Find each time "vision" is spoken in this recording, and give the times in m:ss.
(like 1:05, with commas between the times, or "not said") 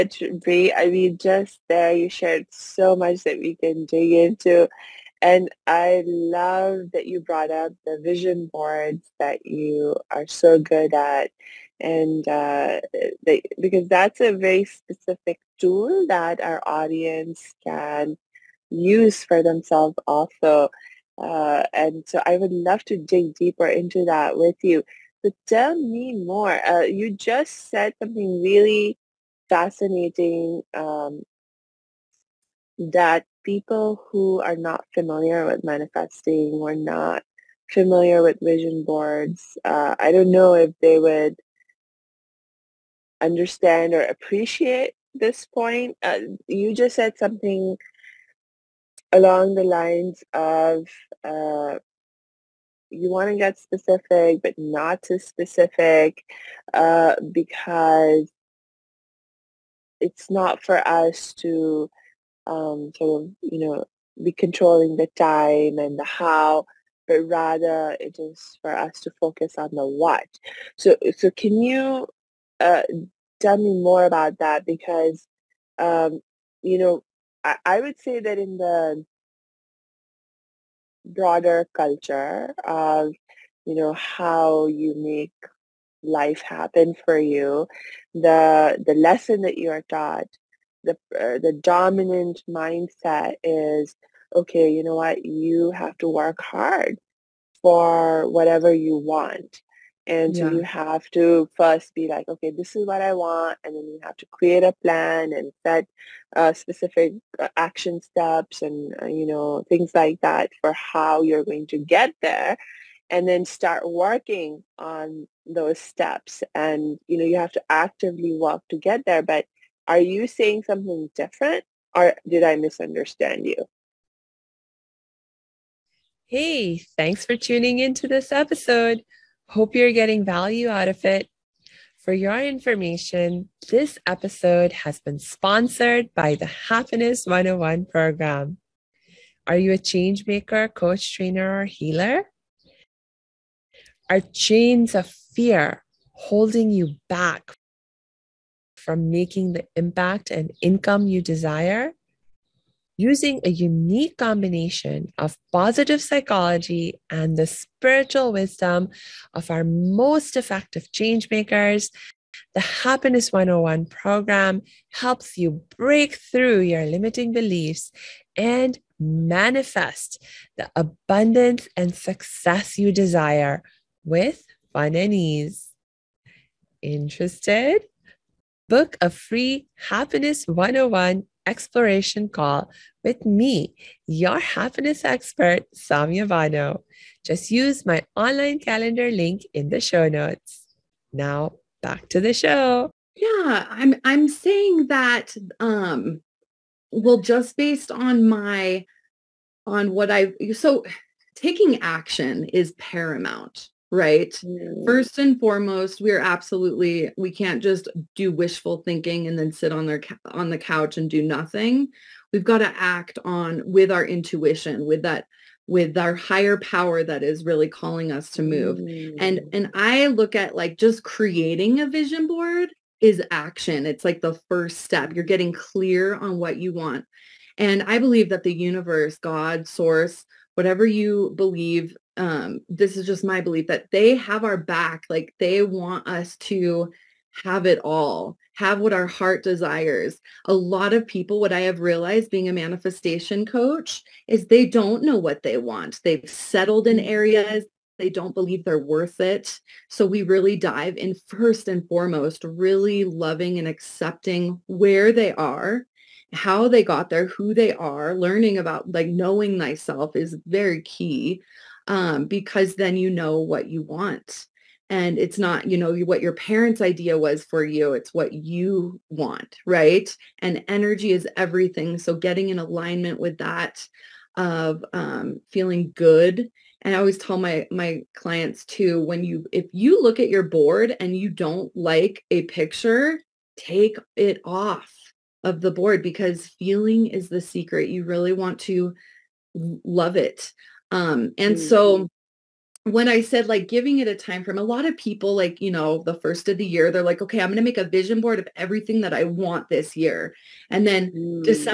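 0:08, 0:38, 3:41, 4:57.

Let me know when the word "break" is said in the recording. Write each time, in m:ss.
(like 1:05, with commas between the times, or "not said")
2:45.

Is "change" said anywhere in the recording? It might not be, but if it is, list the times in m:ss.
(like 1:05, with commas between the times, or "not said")
2:19, 2:40.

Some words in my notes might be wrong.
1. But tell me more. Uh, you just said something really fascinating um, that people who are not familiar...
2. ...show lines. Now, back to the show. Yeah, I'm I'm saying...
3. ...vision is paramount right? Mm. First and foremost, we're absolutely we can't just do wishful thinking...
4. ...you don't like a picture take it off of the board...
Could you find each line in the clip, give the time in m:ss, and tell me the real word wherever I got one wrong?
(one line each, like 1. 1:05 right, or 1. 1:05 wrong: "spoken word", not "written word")
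1. 0:25 right
2. 3:09 wrong: "notes", not "lines"
3. 3:21 wrong: "action", not "vision"
4. 4:41 right.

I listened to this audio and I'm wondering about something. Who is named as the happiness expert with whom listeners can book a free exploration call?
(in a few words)
Samia Bano.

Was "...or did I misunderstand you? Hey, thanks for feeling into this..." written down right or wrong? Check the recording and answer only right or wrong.
wrong.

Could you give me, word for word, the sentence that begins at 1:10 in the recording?
So, so can you uh, tell me more about that?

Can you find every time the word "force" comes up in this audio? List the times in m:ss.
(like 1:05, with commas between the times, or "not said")
not said.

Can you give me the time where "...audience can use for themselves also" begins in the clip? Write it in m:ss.
0:16.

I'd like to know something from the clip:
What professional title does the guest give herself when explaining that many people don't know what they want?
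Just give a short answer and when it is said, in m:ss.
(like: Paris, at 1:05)
Manifestation coach, at 4:02.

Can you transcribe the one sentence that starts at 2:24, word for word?
Are chains of fear holding you back from making the impact and income you desire?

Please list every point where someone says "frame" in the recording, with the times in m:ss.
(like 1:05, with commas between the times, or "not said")
4:54.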